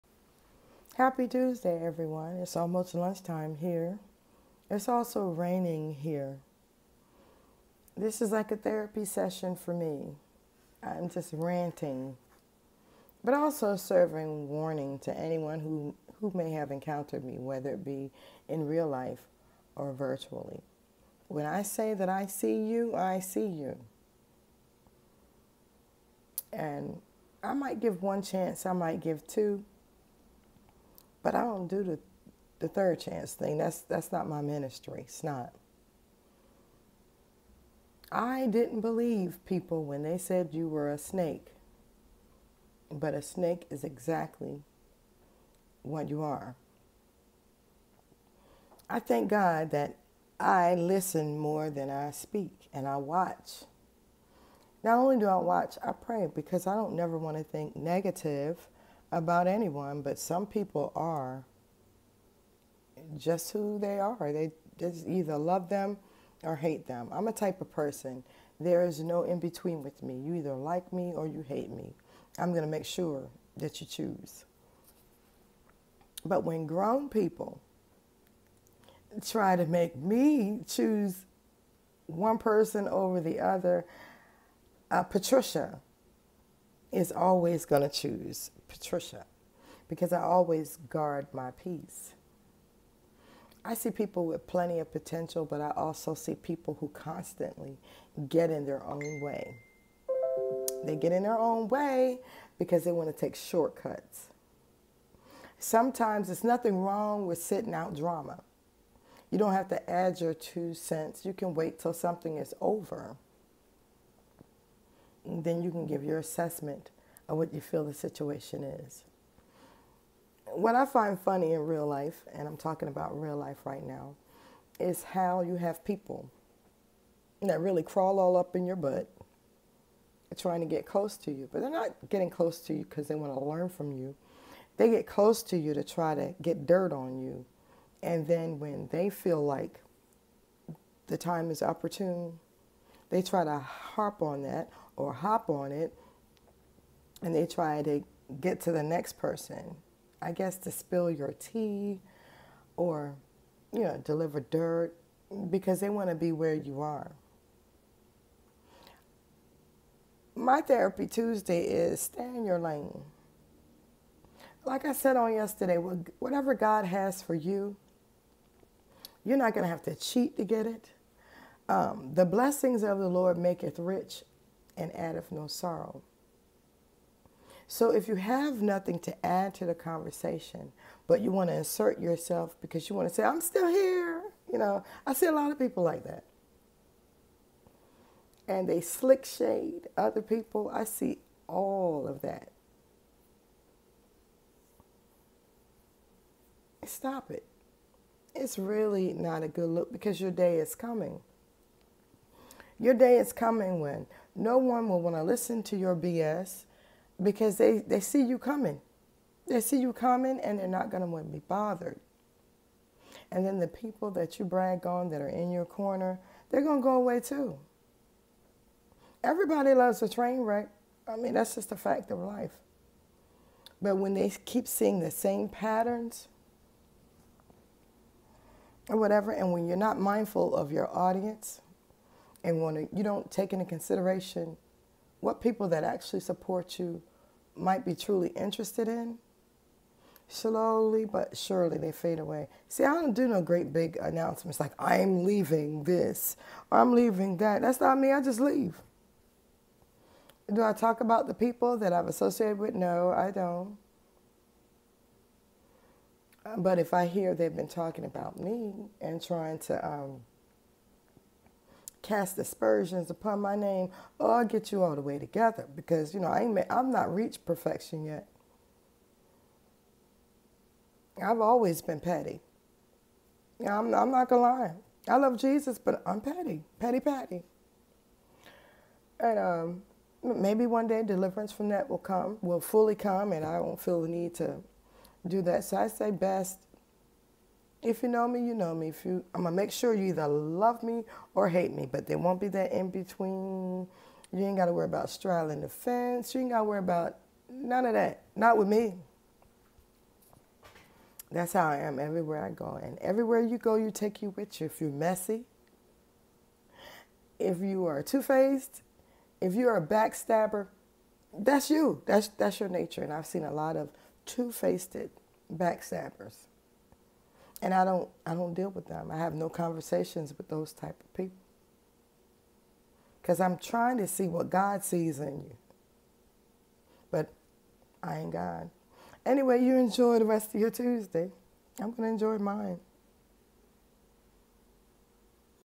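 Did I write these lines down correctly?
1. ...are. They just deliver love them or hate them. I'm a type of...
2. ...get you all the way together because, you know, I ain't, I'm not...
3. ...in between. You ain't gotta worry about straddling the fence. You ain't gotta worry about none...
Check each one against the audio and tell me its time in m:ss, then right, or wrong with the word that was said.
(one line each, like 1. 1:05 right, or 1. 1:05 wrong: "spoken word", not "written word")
1. 1:03 wrong: "either", not "deliver"
2. 4:24 right
3. 4:52 right.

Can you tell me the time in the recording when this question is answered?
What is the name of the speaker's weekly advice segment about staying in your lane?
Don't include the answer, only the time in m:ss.
2:40.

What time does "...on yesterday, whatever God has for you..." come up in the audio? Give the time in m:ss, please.
2:45.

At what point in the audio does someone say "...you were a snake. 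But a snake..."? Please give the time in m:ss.
0:40.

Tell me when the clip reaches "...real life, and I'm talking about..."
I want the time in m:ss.
2:01.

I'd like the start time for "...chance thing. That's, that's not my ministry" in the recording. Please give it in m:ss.
0:32.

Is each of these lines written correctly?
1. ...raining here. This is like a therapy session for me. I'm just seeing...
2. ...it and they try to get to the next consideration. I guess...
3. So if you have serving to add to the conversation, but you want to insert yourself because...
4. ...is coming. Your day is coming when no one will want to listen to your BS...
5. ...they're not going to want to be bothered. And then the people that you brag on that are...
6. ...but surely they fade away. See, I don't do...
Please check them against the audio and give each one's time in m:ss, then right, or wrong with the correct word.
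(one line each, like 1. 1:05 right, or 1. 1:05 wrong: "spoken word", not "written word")
1. 0:05 wrong: "ranting", not "seeing"
2. 2:25 wrong: "person", not "consideration"
3. 2:57 wrong: "nothing", not "serving"
4. 3:20 right
5. 3:30 right
6. 4:01 right.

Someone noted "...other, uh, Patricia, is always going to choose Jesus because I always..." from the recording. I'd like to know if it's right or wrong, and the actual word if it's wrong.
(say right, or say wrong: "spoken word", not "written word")
wrong: "Patricia", not "Jesus".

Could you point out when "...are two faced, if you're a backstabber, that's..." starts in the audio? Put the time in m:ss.
5:07.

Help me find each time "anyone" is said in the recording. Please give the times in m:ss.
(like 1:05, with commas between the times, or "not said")
0:15, 0:59.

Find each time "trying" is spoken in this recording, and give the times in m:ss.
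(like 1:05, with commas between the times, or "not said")
2:10, 4:19, 5:23.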